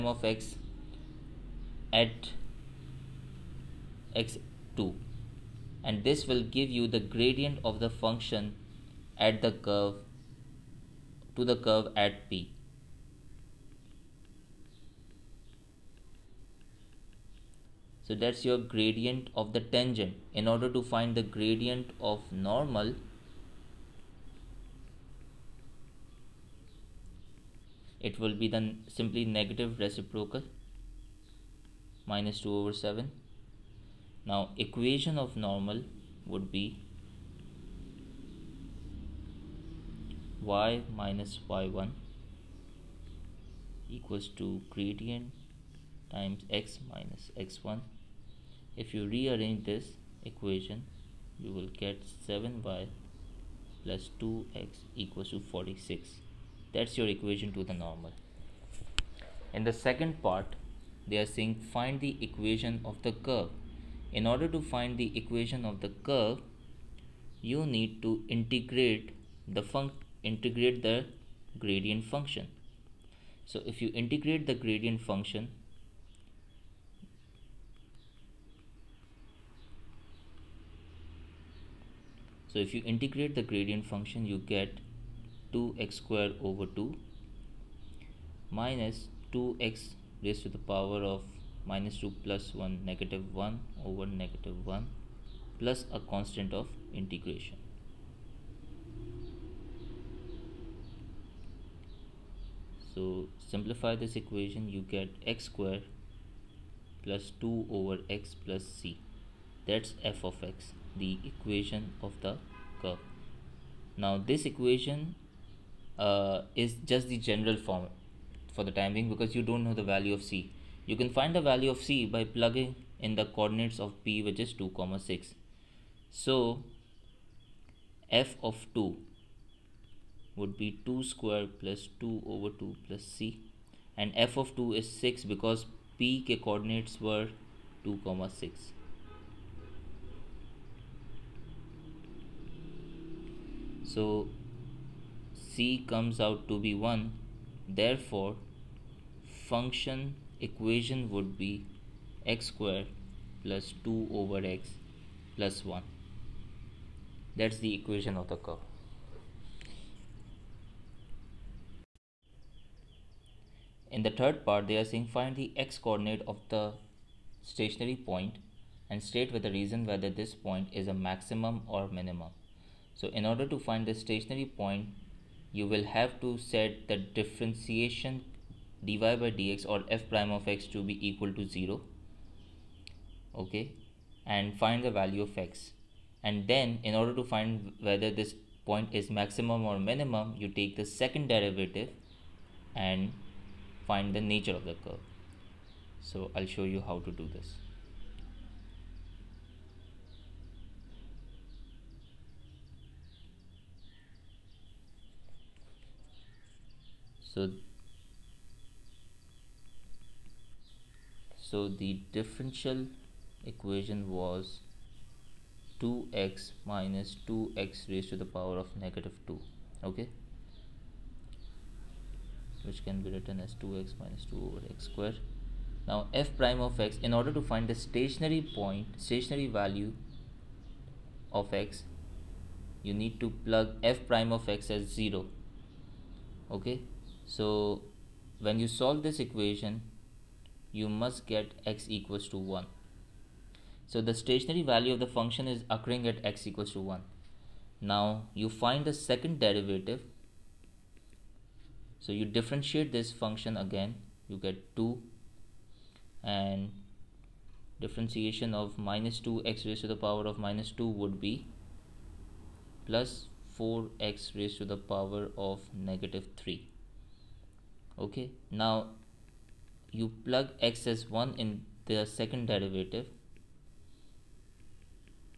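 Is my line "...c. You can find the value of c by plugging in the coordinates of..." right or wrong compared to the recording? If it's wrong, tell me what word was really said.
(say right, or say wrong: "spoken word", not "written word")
right.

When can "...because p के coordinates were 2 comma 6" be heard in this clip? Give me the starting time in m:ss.
2:15.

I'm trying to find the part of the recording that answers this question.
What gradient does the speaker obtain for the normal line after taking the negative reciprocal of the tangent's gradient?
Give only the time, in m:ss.
0:32.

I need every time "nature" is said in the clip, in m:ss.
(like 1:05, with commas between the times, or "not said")
3:14.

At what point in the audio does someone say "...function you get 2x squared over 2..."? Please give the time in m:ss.
1:23.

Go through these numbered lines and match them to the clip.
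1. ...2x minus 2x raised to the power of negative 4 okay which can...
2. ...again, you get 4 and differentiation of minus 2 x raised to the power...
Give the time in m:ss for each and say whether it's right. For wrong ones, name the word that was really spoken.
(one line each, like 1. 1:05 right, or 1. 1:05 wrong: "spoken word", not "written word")
1. 3:35 wrong: "2", not "4"
2. 4:13 wrong: "2", not "4".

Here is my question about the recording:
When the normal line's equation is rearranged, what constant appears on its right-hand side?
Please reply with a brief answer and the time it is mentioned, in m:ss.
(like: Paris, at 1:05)
46, at 0:55.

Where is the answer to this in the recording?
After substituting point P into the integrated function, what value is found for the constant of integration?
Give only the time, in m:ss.
2:25.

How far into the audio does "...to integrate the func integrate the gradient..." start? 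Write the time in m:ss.
1:08.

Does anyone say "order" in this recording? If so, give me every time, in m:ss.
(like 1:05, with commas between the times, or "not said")
0:20, 1:04, 2:53, 3:06, 3:47.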